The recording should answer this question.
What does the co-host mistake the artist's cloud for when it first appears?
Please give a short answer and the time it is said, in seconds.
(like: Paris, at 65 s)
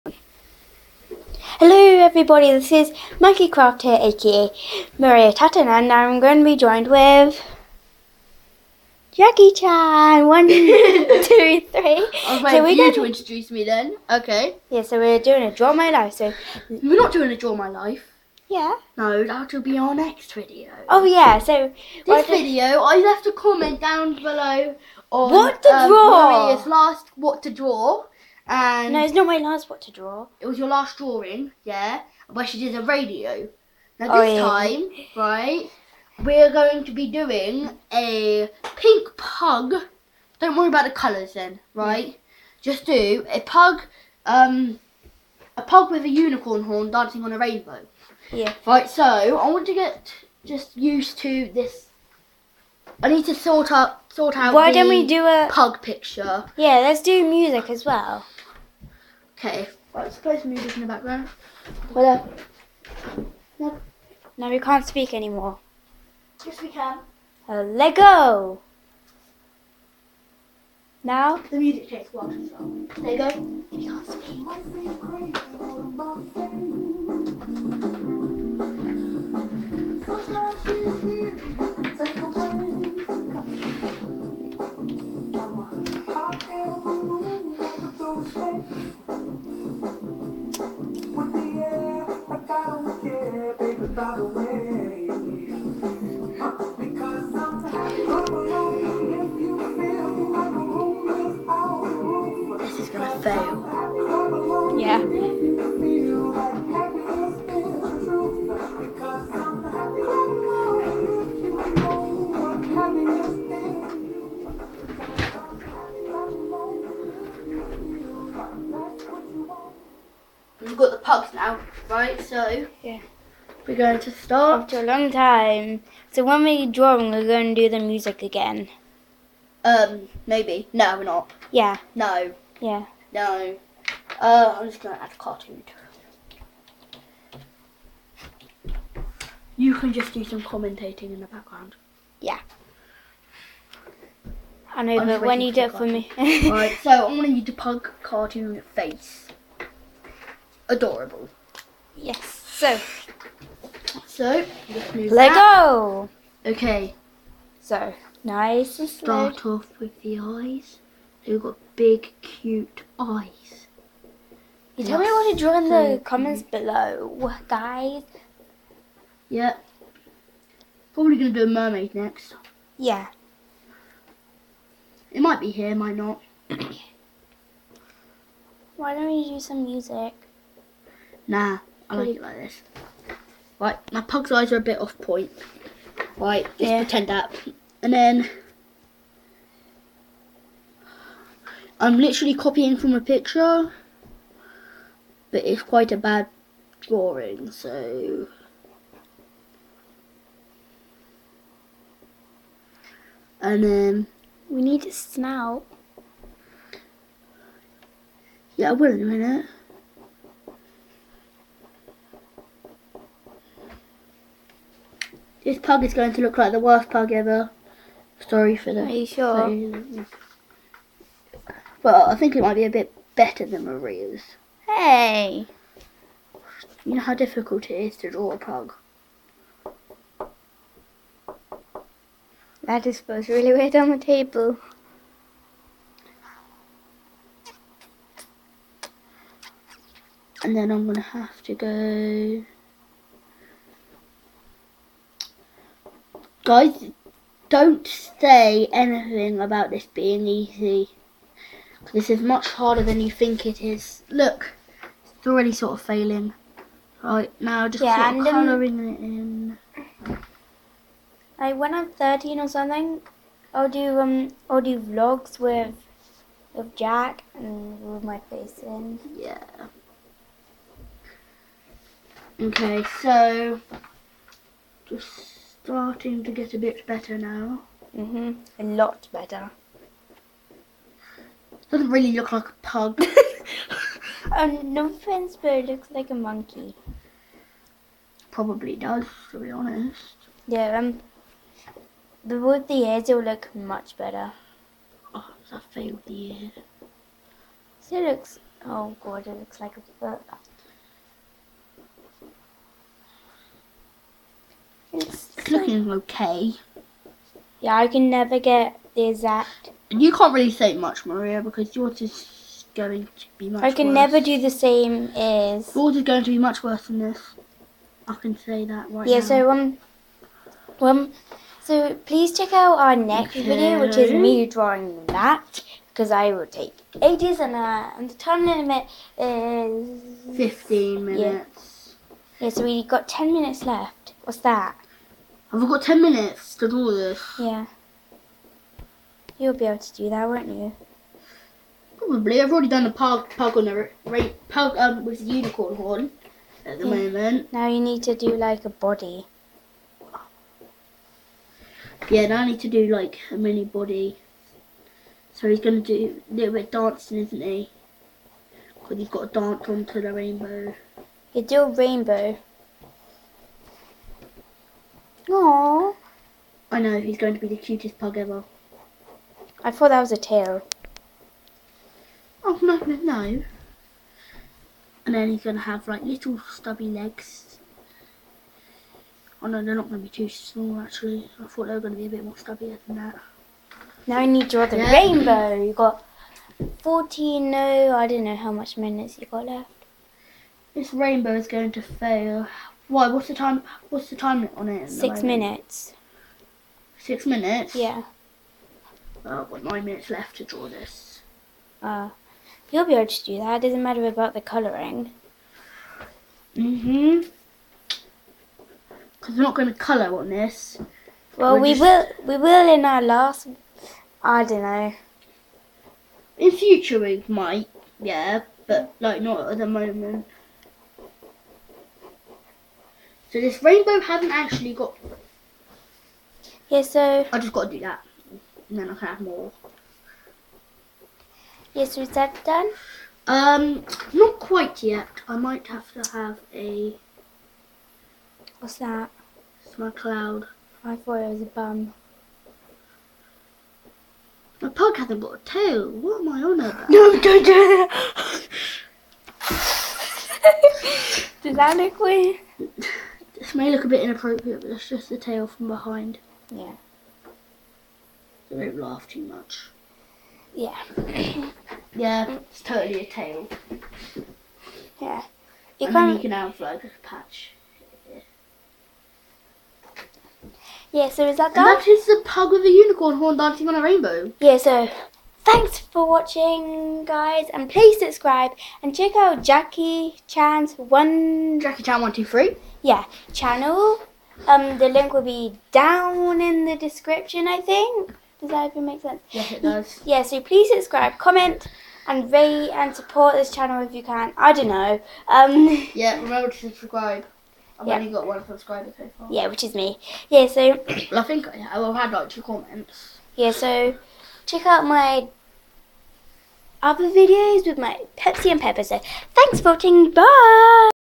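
A bum, at 441 s.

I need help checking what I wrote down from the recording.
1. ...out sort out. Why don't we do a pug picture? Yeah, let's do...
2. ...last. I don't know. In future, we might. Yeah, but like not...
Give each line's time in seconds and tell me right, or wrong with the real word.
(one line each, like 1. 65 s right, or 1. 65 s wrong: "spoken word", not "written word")
1. 53 s right
2. 413 s right.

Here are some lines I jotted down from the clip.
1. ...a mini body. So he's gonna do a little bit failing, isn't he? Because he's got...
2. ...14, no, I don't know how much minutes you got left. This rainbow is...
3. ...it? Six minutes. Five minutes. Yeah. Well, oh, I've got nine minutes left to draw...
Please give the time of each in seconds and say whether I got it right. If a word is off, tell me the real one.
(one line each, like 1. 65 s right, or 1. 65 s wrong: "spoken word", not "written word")
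1. 353 s wrong: "dancing", not "failing"
2. 386 s right
3. 394 s wrong: "Six", not "Five".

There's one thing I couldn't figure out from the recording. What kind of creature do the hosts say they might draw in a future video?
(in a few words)
A mermaid.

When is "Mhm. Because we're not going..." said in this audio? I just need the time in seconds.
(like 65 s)
406 s.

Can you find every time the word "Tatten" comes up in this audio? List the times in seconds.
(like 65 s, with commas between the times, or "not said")
5 s.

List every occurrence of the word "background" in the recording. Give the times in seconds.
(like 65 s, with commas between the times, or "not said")
60 s, 141 s.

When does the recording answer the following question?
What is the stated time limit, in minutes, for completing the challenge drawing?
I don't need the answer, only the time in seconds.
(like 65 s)
330 s.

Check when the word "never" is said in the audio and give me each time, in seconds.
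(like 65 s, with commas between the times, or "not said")
308 s, 313 s.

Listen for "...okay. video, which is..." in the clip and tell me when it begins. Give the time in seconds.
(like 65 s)
323 s.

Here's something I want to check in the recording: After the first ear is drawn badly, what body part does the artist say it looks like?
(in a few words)
A foot.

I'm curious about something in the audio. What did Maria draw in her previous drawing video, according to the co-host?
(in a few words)
A radio.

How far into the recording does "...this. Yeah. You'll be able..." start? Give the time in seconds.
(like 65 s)
336 s.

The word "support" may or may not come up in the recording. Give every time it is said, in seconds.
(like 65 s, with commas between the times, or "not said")
492 s.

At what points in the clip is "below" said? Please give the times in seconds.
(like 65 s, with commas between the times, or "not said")
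24 s, 166 s.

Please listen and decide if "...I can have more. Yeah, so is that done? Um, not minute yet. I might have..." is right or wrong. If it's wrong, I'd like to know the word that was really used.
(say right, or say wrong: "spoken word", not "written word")
wrong: "quite", not "minute".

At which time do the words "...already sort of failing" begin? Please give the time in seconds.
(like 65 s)
255 s.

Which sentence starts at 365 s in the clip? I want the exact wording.
Oh, I know, he's going to be the cutest pug ever.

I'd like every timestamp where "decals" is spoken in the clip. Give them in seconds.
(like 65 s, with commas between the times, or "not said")
not said.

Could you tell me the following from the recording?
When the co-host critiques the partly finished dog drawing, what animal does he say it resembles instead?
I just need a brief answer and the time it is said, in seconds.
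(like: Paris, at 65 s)
A monkey, at 286 s.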